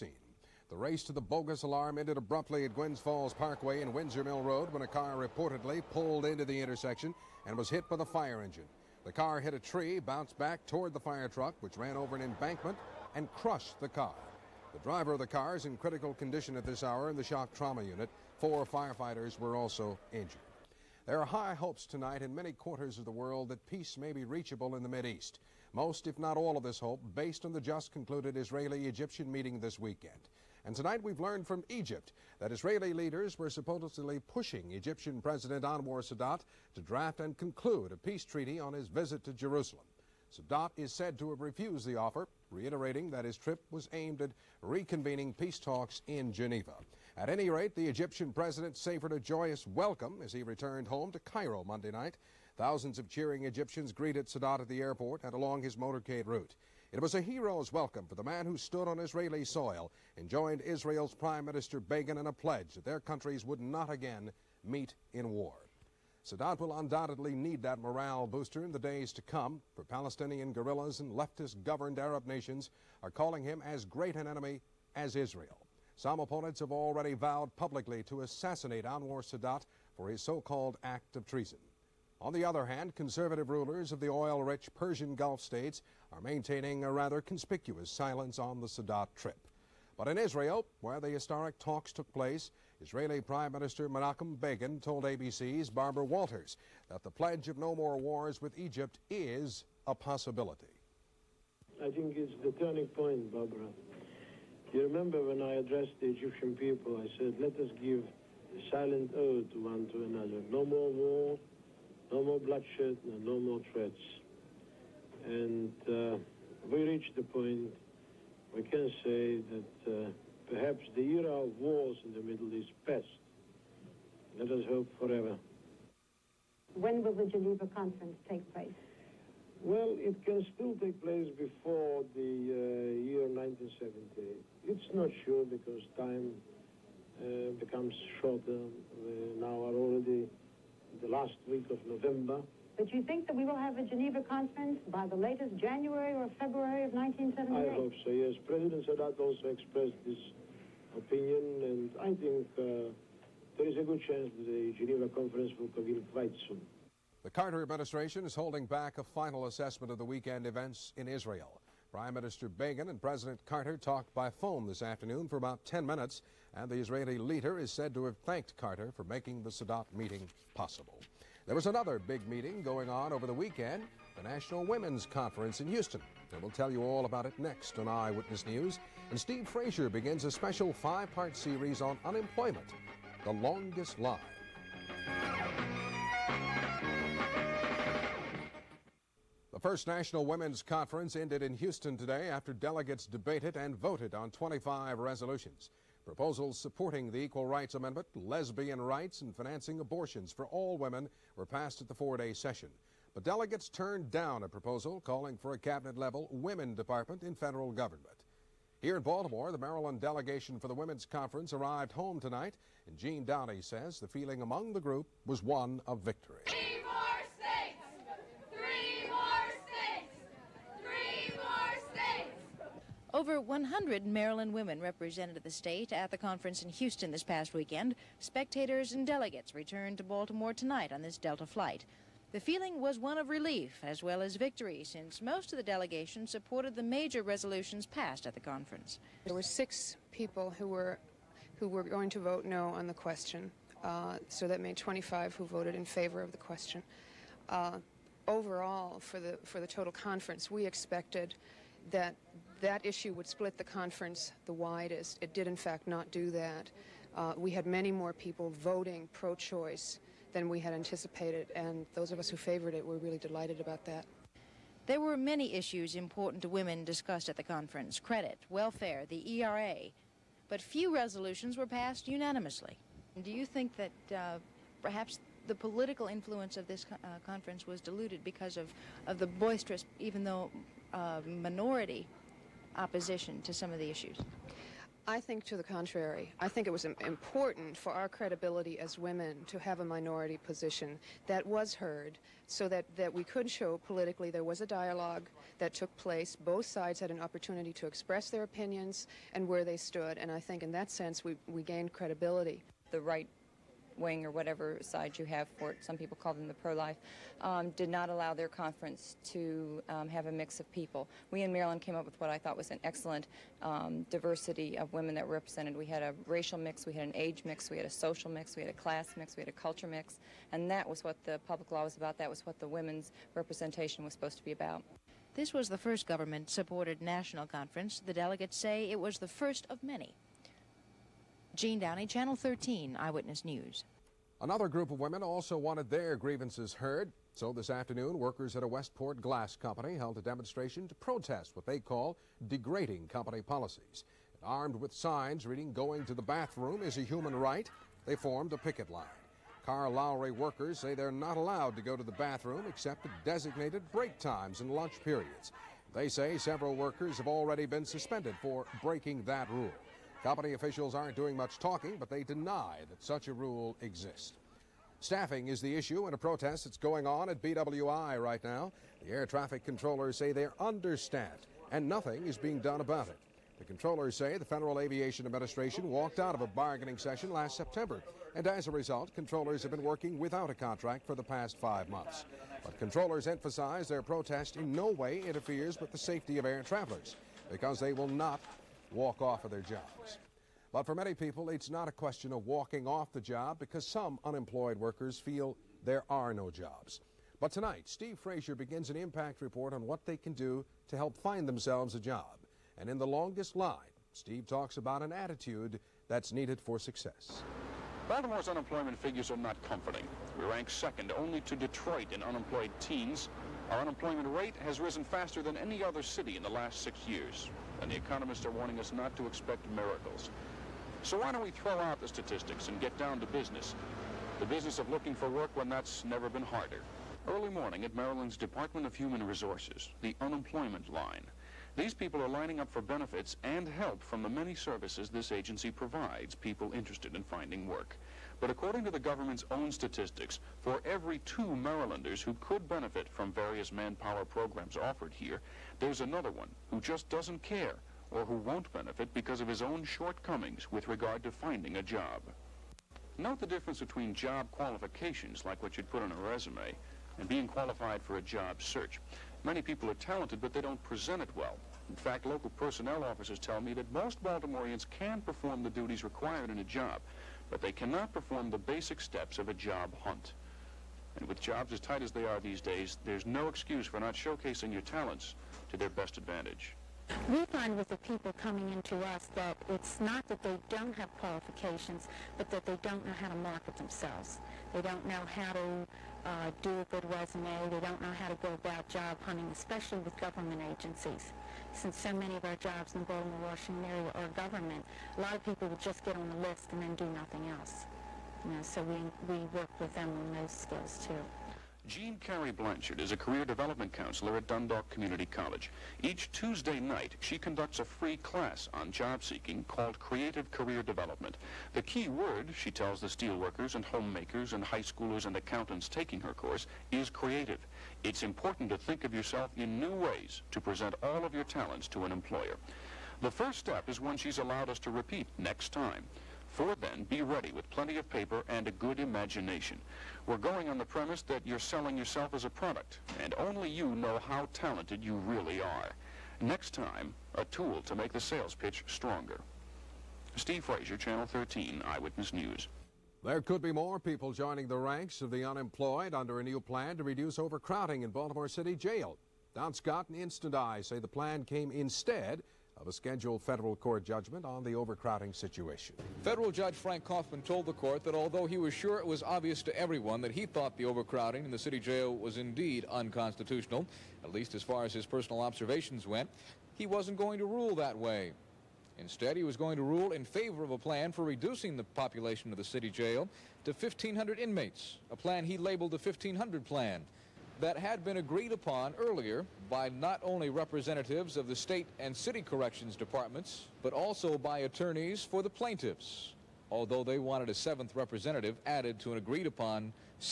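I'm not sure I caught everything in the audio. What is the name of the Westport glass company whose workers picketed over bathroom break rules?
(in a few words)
Carr-Lowrey.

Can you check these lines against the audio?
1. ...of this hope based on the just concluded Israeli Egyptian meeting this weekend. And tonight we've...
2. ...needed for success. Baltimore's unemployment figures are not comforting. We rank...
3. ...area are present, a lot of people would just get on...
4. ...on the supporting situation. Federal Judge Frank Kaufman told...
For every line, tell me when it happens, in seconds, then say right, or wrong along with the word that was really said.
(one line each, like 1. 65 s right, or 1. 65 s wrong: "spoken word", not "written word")
1. 26 s right
2. 406 s right
3. 493 s wrong: "government", not "present"
4. 554 s wrong: "overcrowding", not "supporting".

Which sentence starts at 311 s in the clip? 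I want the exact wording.
We in Maryland came up with what I thought was an excellent um, diversity of women that were represented.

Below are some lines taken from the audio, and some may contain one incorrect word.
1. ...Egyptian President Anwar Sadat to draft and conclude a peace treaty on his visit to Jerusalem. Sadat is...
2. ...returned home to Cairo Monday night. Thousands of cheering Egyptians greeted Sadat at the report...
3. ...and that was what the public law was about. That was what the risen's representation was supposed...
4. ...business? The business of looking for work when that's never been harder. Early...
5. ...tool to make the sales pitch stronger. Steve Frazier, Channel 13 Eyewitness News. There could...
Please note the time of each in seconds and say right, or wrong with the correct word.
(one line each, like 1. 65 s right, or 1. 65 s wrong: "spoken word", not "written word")
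1. 34 s right
2. 50 s wrong: "airport", not "report"
3. 320 s wrong: "women", not "risen"
4. 423 s right
5. 537 s right.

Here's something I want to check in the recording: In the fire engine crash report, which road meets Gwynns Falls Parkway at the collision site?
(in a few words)
Windsor Mill Road.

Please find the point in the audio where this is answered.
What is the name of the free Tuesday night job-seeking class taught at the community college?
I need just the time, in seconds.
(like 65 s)
509 s.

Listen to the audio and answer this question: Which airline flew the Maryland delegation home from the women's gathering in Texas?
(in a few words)
Delta.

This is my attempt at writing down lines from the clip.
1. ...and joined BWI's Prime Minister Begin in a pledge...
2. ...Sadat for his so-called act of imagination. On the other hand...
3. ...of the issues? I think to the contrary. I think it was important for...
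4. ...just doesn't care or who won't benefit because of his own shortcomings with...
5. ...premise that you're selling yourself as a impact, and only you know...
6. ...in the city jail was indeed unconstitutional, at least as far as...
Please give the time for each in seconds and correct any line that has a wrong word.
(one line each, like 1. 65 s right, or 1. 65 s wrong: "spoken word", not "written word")
1. 60 s wrong: "Israel", not "BWI"
2. 79 s wrong: "treason", not "imagination"
3. 283 s right
4. 446 s right
5. 530 s wrong: "product", not "impact"
6. 561 s right.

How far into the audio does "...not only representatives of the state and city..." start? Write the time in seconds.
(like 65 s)
579 s.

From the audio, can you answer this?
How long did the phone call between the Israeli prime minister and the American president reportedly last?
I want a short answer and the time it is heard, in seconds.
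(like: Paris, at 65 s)
10 minutes, at 165 s.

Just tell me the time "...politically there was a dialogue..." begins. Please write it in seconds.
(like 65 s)
293 s.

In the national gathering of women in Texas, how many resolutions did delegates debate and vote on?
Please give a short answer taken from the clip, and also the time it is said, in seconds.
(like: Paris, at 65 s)
25, at 194 s.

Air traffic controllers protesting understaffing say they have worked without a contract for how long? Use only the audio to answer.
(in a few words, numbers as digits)
5 months.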